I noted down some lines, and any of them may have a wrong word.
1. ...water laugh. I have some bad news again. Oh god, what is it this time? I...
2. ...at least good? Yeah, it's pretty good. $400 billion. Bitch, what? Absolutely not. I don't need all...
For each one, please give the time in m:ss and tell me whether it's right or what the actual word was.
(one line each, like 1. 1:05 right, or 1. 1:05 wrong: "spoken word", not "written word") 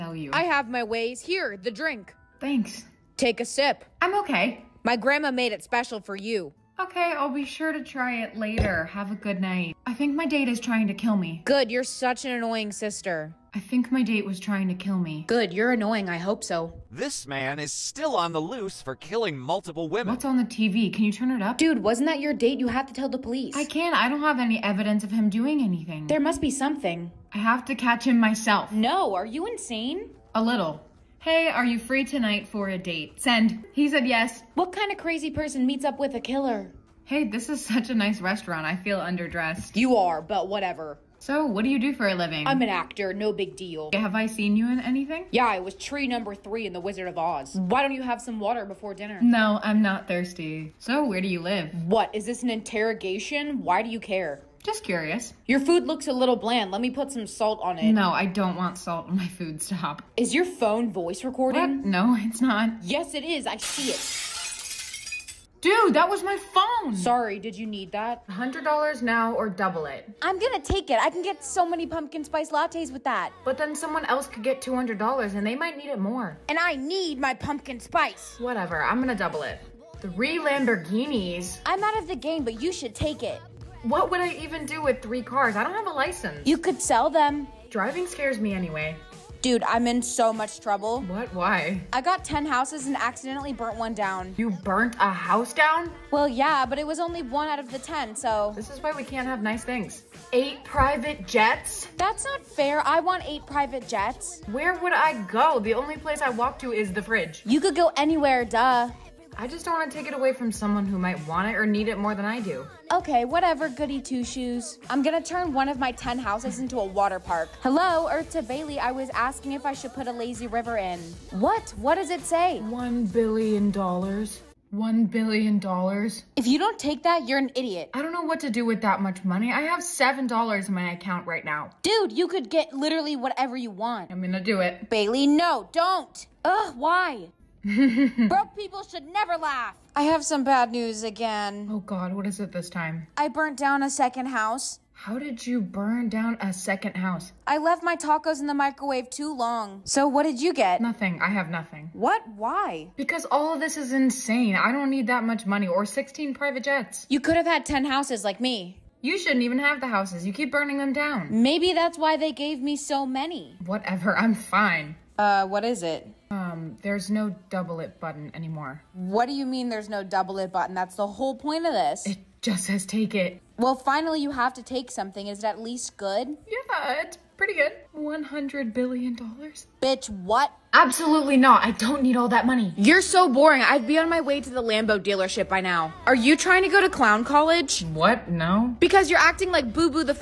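1. 2:19 wrong: "never", not "water"
2. 2:55 wrong: "100", not "400".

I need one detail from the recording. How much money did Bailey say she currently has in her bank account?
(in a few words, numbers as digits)
$7.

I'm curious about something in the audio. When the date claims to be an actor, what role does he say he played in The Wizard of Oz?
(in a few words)
Tree number 3.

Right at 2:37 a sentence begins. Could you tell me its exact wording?
You could have had 10 houses like me.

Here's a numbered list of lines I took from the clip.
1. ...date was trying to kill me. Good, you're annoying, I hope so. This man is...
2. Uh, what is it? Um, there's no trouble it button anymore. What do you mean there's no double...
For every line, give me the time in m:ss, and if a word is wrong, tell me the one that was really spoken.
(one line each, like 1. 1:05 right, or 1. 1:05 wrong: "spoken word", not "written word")
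1. 0:14 right
2. 2:45 wrong: "double", not "trouble".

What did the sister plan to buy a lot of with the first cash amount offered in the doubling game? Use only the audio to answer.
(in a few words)
Pumpkin spice lattes.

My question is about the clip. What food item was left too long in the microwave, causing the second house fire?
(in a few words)
Tacos.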